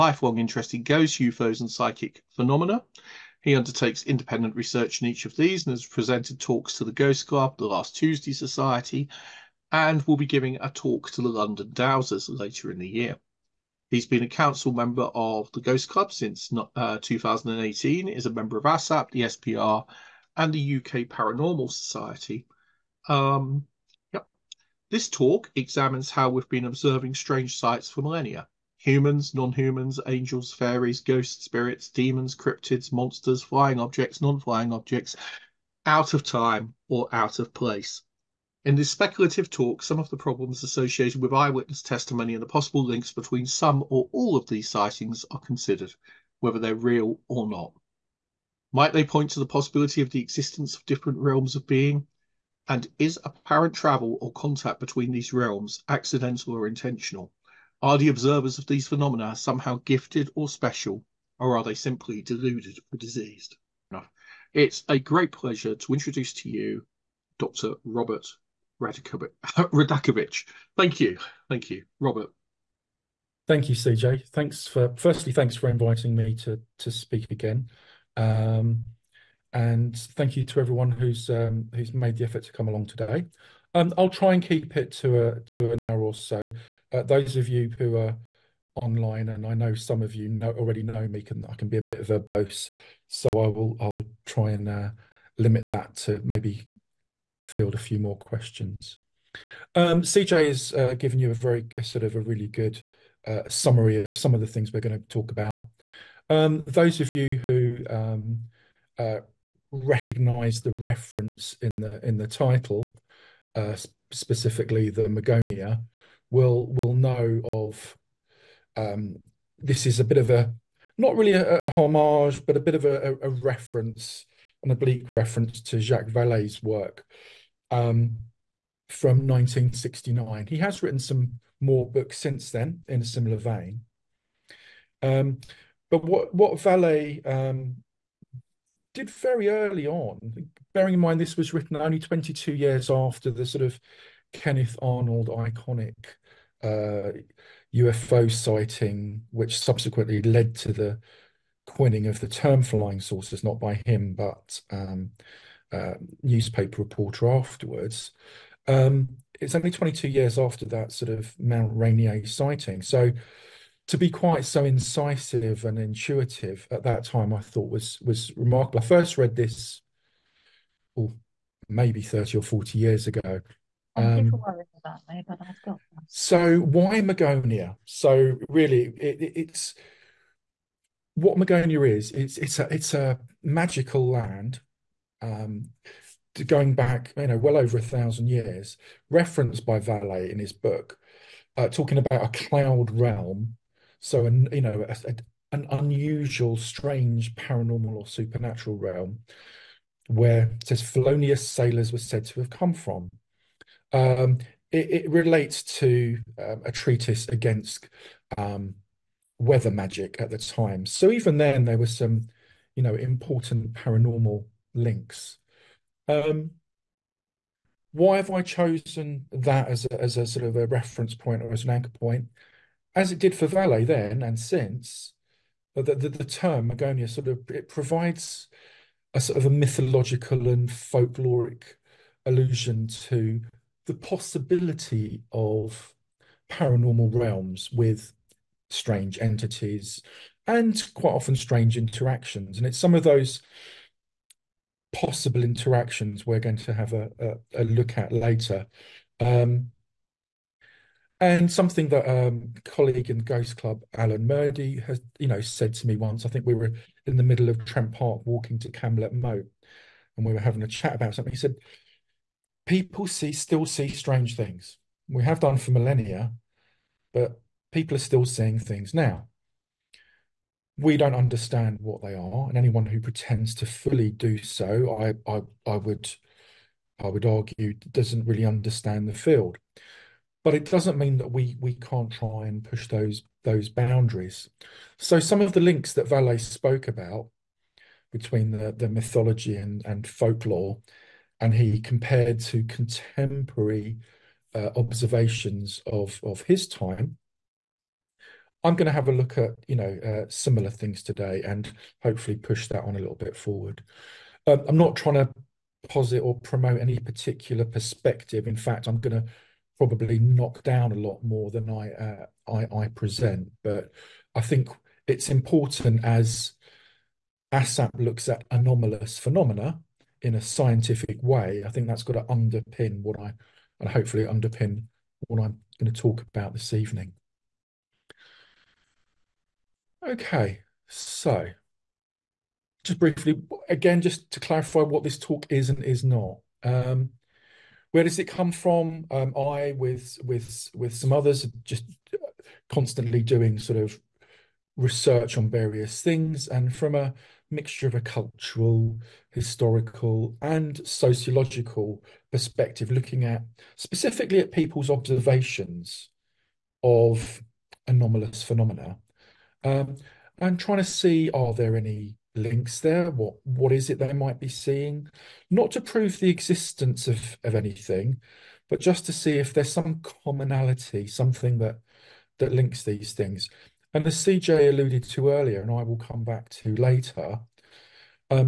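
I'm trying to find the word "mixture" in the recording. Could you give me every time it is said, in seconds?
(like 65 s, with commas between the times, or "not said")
347 s.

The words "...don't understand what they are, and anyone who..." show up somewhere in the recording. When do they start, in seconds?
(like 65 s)
270 s.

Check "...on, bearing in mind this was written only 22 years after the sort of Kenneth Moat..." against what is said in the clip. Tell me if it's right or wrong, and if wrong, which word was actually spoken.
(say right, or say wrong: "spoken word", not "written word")
wrong: "Arnold", not "Moat".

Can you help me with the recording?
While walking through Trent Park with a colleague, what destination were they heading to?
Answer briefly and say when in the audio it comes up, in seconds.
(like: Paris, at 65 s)
Camlet Moat, at 258 s.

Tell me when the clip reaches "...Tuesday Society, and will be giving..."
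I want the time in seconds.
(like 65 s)
7 s.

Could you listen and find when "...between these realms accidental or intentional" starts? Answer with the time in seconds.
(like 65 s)
54 s.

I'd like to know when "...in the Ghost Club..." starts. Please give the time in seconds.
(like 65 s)
253 s.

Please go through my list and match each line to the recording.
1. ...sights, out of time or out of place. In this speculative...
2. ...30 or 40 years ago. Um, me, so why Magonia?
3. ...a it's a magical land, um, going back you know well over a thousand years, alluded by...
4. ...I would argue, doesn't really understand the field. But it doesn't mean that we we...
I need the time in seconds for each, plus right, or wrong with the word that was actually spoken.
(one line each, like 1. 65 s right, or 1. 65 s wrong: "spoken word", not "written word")
1. 34 s wrong: "objects", not "sights"
2. 172 s right
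3. 182 s wrong: "referenced", not "alluded"
4. 276 s right.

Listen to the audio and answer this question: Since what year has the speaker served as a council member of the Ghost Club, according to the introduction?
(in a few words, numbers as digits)
2018.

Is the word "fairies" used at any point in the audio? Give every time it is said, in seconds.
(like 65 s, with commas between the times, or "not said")
30 s.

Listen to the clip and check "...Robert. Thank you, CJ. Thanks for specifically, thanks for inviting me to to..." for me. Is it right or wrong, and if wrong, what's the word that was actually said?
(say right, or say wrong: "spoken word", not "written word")
wrong: "firstly", not "specifically".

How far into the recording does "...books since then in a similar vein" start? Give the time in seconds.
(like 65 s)
131 s.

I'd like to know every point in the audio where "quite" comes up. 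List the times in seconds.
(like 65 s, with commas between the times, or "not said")
164 s, 240 s.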